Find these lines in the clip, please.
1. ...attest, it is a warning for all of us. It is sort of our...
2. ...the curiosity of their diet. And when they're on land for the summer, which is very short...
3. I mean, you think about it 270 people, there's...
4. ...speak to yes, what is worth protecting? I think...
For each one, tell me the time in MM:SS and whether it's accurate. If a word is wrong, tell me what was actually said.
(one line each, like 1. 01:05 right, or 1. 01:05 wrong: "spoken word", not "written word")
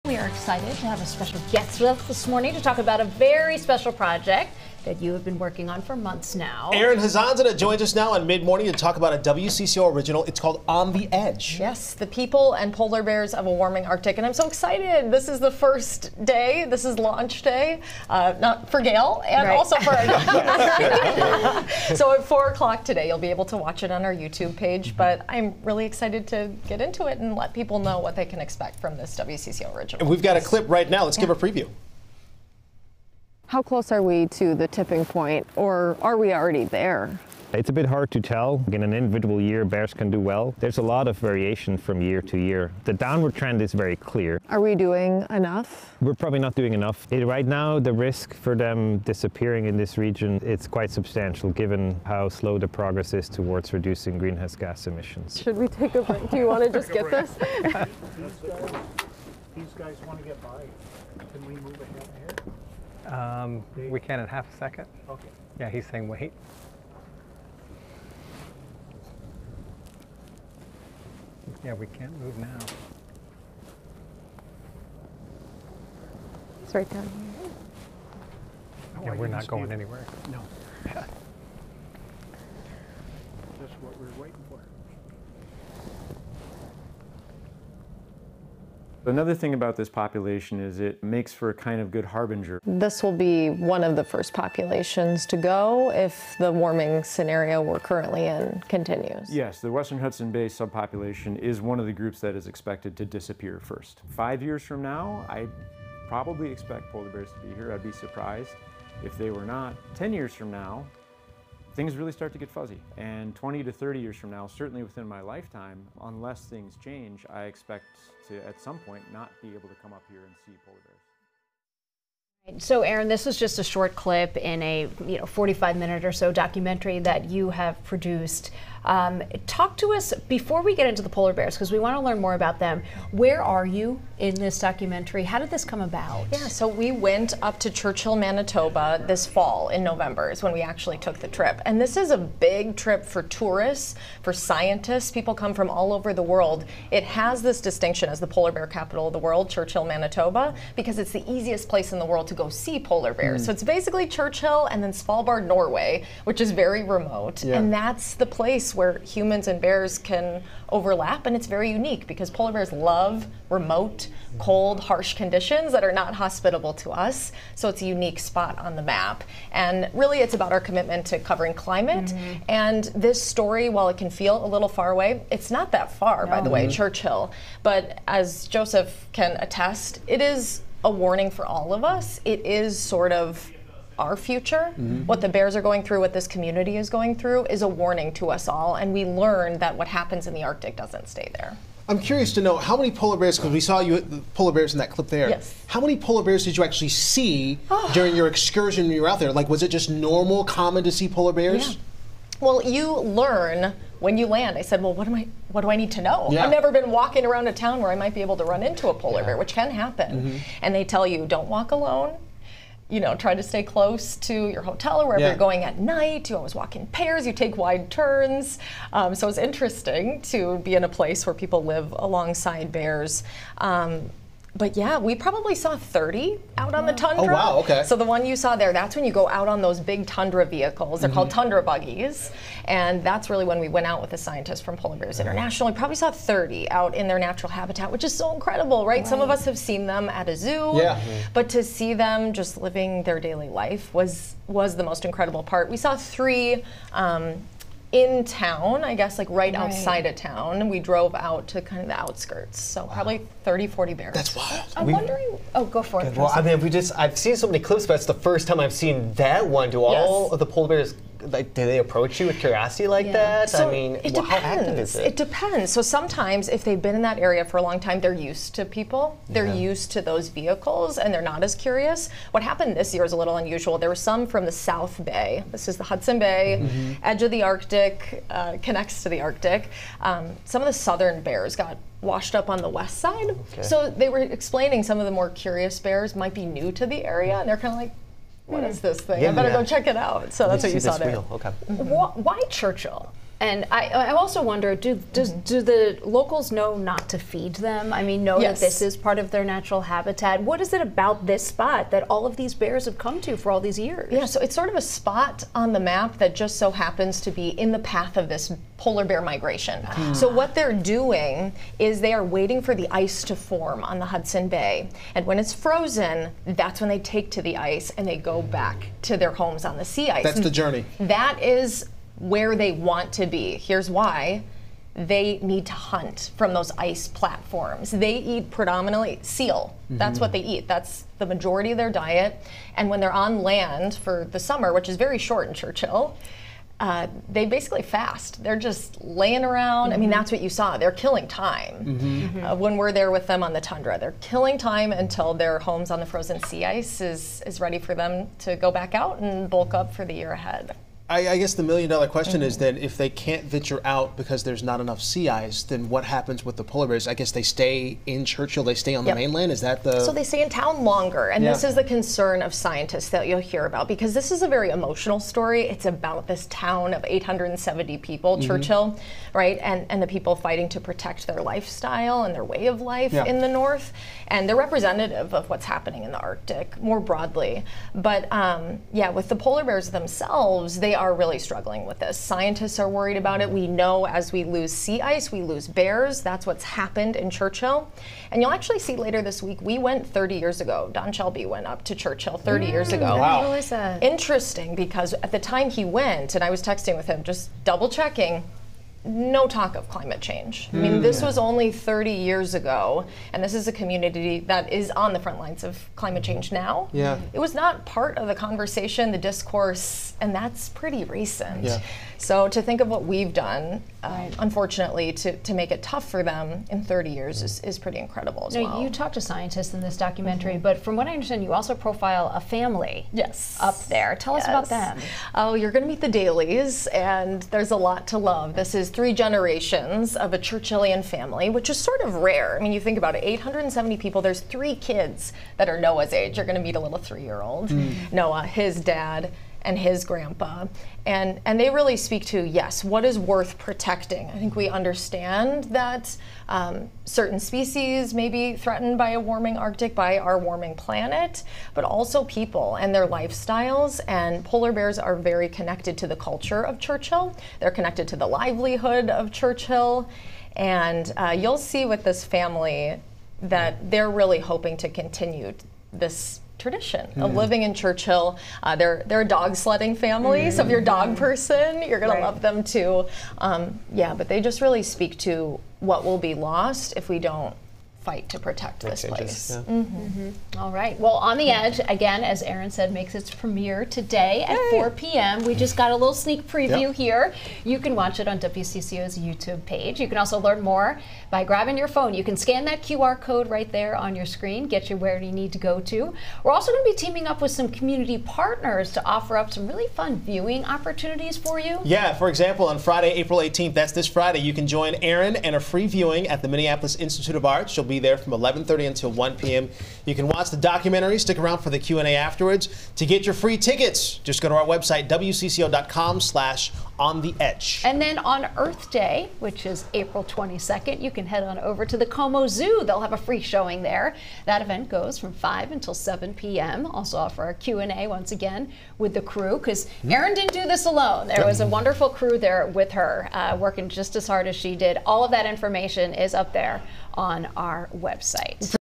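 1. 02:59 right
2. 05:31 wrong: "majority", not "curiosity"
3. 07:12 wrong: "870", not "270"
4. 07:21 right.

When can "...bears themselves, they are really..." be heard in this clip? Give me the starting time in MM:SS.
06:19.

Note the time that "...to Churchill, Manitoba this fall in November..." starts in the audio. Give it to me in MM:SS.
02:17.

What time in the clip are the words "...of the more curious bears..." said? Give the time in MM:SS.
04:45.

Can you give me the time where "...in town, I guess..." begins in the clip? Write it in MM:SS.
04:07.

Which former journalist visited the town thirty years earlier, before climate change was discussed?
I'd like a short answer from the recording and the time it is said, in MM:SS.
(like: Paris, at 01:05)
Don Shelby, at 06:30.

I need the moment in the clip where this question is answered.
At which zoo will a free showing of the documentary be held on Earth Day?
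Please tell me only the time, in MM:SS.
08:42.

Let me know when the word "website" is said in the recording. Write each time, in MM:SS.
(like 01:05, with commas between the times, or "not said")
08:34, 08:57.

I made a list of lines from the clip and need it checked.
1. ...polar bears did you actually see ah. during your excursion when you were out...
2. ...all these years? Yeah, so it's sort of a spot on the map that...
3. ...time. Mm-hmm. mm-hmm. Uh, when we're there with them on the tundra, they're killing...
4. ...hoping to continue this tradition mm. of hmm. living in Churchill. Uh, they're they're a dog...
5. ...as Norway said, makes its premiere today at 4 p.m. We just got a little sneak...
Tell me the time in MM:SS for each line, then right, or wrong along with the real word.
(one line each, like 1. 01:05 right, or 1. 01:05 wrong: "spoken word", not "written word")
1. 03:15 right
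2. 05:03 right
3. 05:41 right
4. 07:44 right
5. 08:02 wrong: "Erin", not "Norway".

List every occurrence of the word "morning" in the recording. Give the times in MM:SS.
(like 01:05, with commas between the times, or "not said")
00:02, 00:08.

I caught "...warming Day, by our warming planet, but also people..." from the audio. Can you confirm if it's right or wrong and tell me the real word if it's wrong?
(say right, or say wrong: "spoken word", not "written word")
wrong: "Arctic", not "Day".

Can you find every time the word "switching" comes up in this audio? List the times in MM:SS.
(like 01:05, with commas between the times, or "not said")
not said.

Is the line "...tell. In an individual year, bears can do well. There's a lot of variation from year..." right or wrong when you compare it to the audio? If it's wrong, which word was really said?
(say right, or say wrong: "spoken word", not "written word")
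right.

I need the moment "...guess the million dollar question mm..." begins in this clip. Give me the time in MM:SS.
05:51.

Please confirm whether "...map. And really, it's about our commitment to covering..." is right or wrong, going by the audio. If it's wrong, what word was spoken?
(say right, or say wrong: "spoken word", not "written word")
right.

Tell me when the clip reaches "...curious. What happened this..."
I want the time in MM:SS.
04:31.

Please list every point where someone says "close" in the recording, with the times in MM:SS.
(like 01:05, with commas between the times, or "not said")
00:33, 03:33.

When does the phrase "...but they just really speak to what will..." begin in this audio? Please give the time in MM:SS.
07:54.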